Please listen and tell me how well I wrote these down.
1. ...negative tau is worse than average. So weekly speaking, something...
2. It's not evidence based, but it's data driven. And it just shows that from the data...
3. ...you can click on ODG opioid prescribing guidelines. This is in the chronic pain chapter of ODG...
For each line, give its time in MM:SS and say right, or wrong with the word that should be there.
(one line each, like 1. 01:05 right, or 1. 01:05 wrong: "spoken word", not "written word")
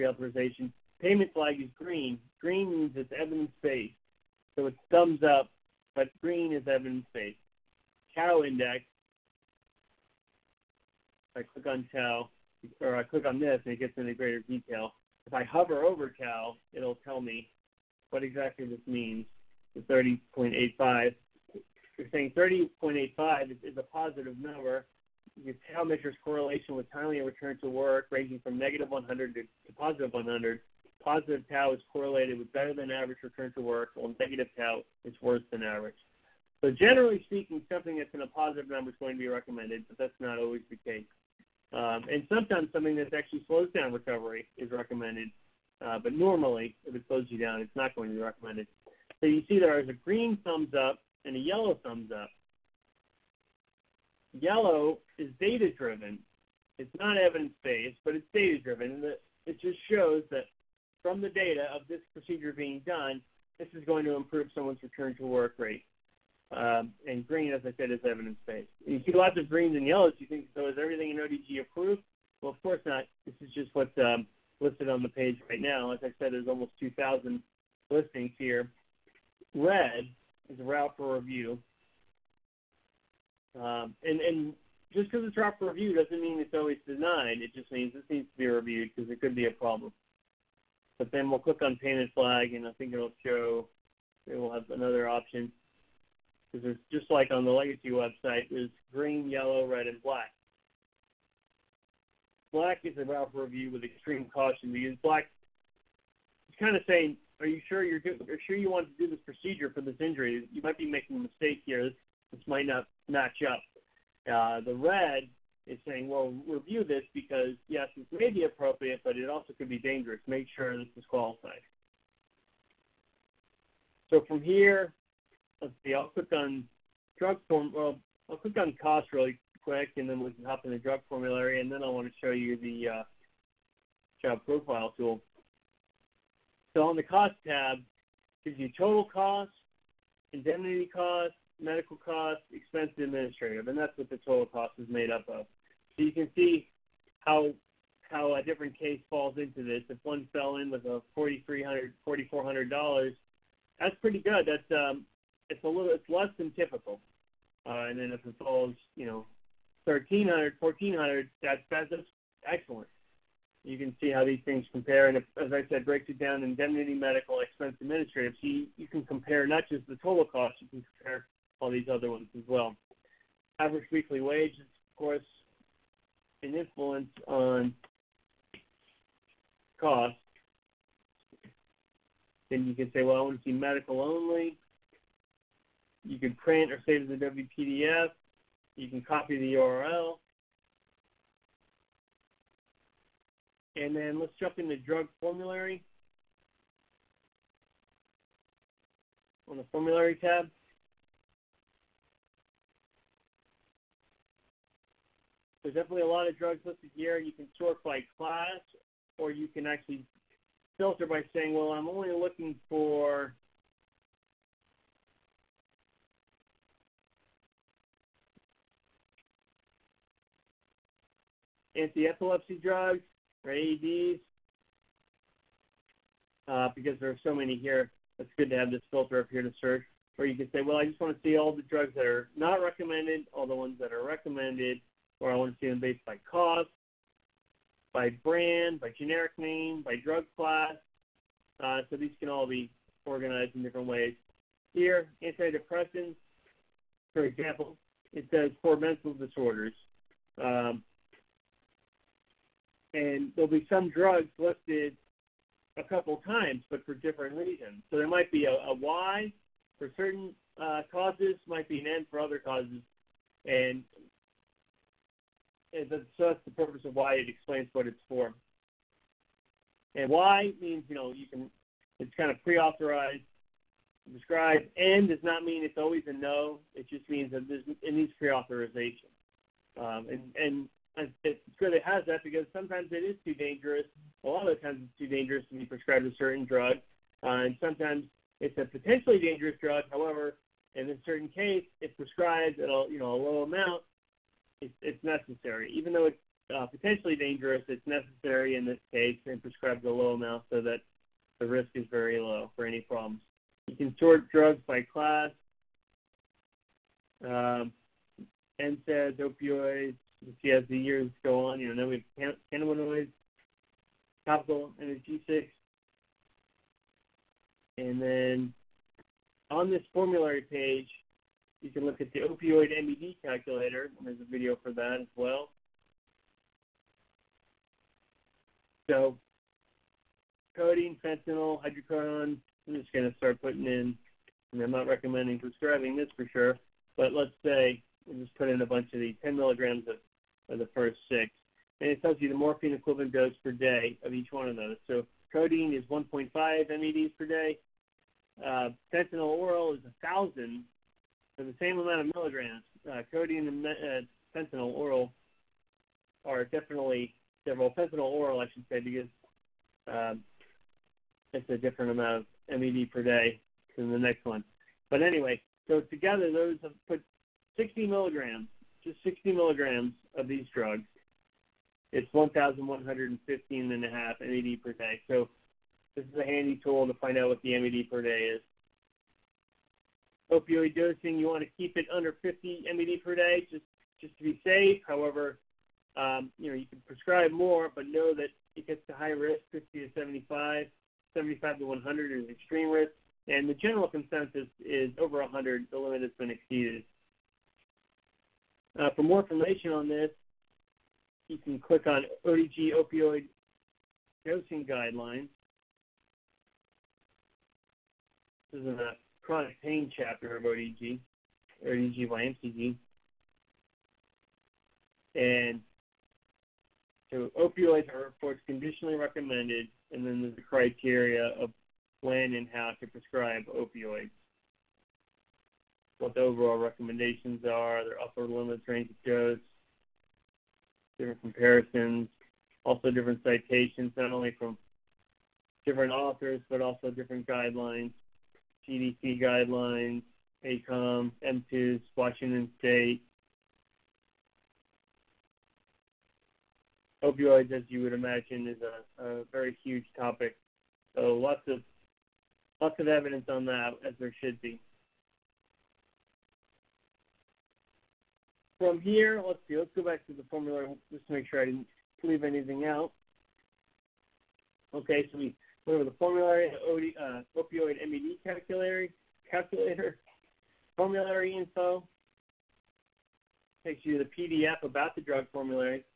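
1. 00:34 wrong: "generally", not "weekly"
2. 00:56 right
3. 06:41 wrong: "dosing", not "prescribing".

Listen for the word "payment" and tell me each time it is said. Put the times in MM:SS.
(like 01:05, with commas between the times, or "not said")
00:01, 01:31.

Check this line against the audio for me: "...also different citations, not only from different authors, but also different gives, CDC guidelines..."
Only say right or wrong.
wrong.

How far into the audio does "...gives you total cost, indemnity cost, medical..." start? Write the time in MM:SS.
02:18.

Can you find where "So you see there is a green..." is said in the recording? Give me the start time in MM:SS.
00:49.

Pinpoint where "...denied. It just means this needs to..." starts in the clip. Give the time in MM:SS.
01:26.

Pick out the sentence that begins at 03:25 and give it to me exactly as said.
There's definitely a lot of drugs listed here.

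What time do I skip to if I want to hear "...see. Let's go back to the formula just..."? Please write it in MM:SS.
07:39.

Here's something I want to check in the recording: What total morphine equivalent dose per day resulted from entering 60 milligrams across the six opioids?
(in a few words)
1,115.5.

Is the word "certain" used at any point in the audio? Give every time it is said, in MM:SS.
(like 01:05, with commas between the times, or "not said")
04:19, 04:46, 04:51.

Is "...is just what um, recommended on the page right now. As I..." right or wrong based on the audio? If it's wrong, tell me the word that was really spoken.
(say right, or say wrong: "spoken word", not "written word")
wrong: "listed", not "recommended".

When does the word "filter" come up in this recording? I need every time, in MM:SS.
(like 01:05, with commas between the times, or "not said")
03:30, 03:48.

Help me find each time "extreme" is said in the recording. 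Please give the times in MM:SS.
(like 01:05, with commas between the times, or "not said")
01:43, 06:32.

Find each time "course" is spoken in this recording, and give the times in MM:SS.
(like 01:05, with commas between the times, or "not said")
01:12, 02:54, 06:58.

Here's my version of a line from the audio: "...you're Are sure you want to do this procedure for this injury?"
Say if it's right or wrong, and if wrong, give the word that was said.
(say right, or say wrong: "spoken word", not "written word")
right.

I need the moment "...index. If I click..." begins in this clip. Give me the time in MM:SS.
00:08.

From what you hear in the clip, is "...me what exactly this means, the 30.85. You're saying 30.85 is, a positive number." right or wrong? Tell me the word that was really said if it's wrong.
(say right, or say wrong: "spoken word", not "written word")
right.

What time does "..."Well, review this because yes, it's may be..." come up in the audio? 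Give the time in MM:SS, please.
01:56.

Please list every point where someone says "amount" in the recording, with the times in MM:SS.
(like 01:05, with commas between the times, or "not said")
04:53, 05:00, 05:51, 06:01.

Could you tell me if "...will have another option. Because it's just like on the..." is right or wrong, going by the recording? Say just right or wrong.
right.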